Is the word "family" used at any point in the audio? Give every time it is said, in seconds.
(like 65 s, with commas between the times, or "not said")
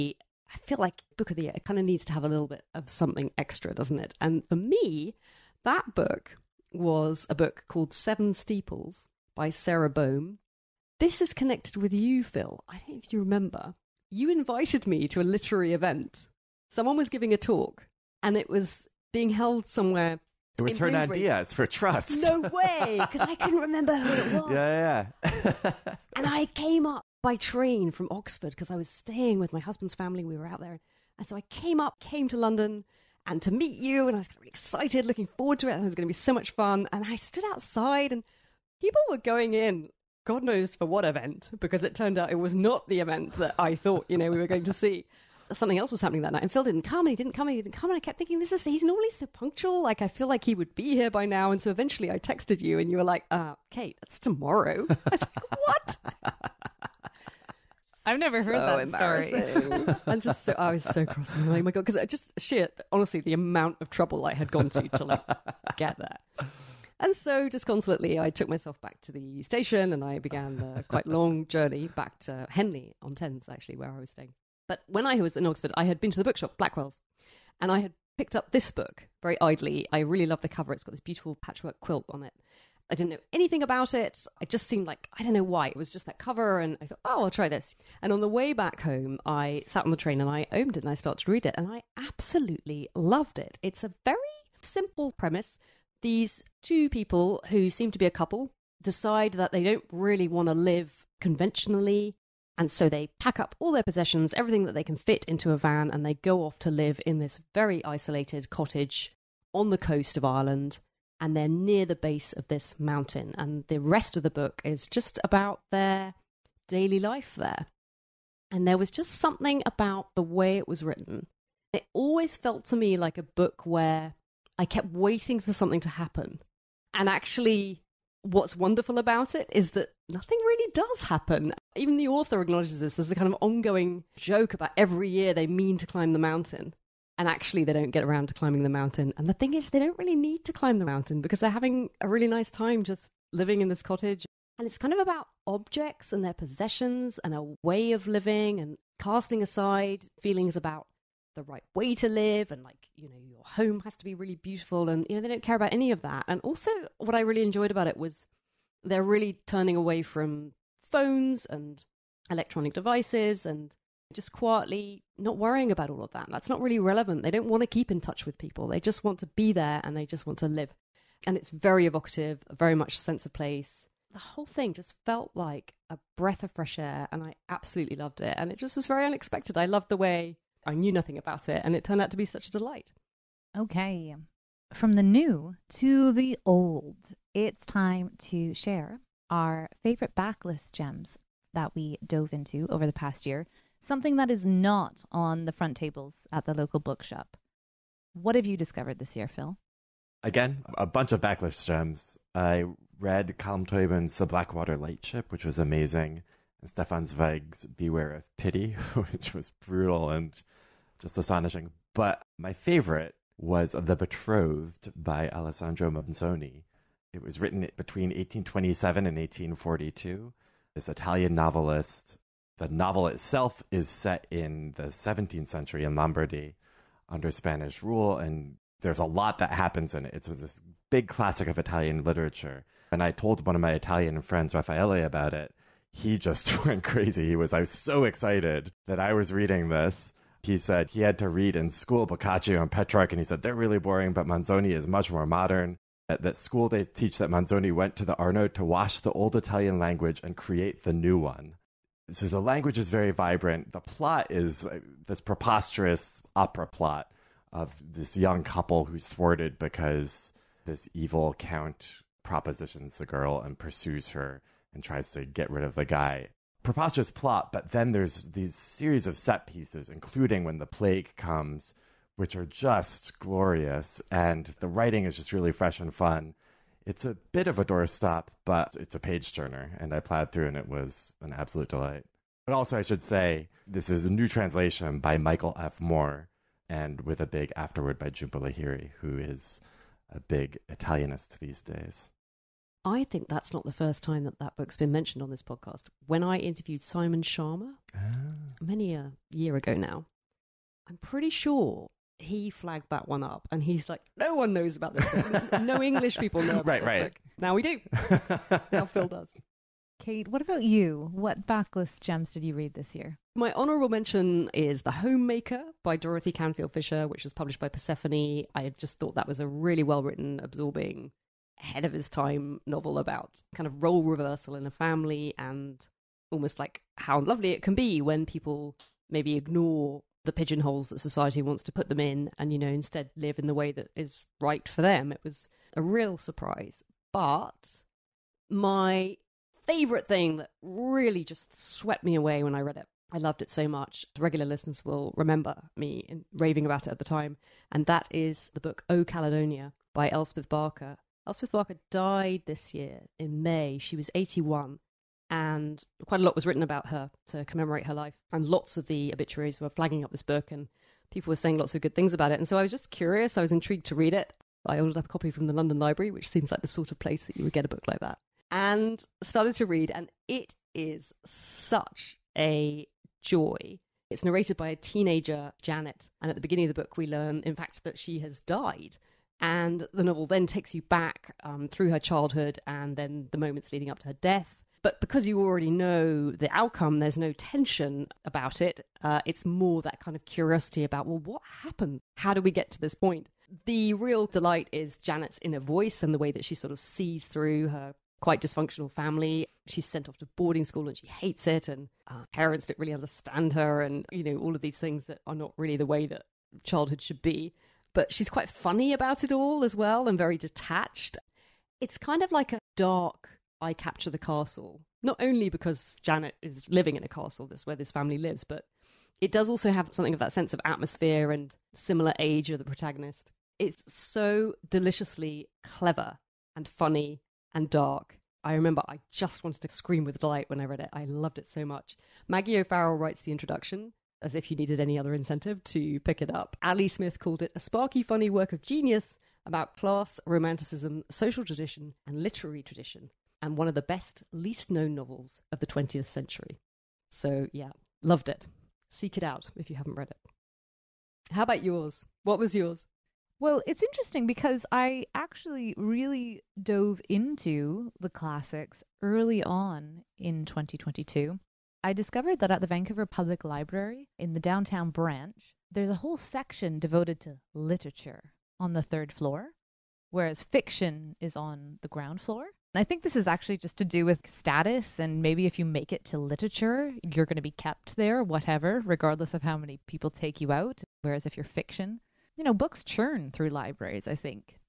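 29 s, 324 s, 398 s, 417 s.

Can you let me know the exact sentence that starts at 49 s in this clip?
Like, I feel like he would be here by now.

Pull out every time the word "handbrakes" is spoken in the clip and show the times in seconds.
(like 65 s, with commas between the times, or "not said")
not said.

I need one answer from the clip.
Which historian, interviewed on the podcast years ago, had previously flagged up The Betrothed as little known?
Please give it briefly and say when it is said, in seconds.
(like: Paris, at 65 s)
Simon Schama, at 296 s.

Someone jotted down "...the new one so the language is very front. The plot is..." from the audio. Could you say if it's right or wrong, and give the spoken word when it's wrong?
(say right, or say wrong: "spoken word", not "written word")
wrong: "vibrant", not "front".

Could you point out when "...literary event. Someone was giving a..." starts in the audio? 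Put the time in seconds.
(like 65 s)
15 s.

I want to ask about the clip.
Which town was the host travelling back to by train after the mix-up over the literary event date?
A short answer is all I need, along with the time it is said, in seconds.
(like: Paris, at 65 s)
Henley on Thames, at 72 s.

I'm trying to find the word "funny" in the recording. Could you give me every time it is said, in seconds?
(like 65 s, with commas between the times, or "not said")
408 s, 426 s, 438 s.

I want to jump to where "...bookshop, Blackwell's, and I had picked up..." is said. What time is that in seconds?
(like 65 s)
76 s.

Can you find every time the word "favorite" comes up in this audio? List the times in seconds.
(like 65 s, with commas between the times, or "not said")
189 s, 212 s, 339 s.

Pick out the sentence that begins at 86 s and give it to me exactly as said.
And I thought, oh, I'll try this.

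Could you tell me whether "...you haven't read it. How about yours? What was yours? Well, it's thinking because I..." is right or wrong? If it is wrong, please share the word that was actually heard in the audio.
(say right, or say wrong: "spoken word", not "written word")
wrong: "interesting", not "thinking".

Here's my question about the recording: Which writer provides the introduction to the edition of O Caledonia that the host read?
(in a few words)
Maggie O'Farrell.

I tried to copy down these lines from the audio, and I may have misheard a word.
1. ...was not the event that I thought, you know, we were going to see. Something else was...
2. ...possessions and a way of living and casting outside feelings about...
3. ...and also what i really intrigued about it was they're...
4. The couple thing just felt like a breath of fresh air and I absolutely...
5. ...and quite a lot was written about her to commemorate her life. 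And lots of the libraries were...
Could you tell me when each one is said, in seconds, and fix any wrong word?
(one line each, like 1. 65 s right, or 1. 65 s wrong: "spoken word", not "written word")
1. 42 s right
2. 146 s wrong: "aside", not "outside"
3. 156 s wrong: "enjoyed", not "intrigued"
4. 174 s wrong: "whole", not "couple"
5. 355 s wrong: "obituaries", not "libraries".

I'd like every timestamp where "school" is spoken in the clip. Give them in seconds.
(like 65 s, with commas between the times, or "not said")
241 s, 246 s, 400 s.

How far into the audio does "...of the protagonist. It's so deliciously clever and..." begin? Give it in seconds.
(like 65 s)
422 s.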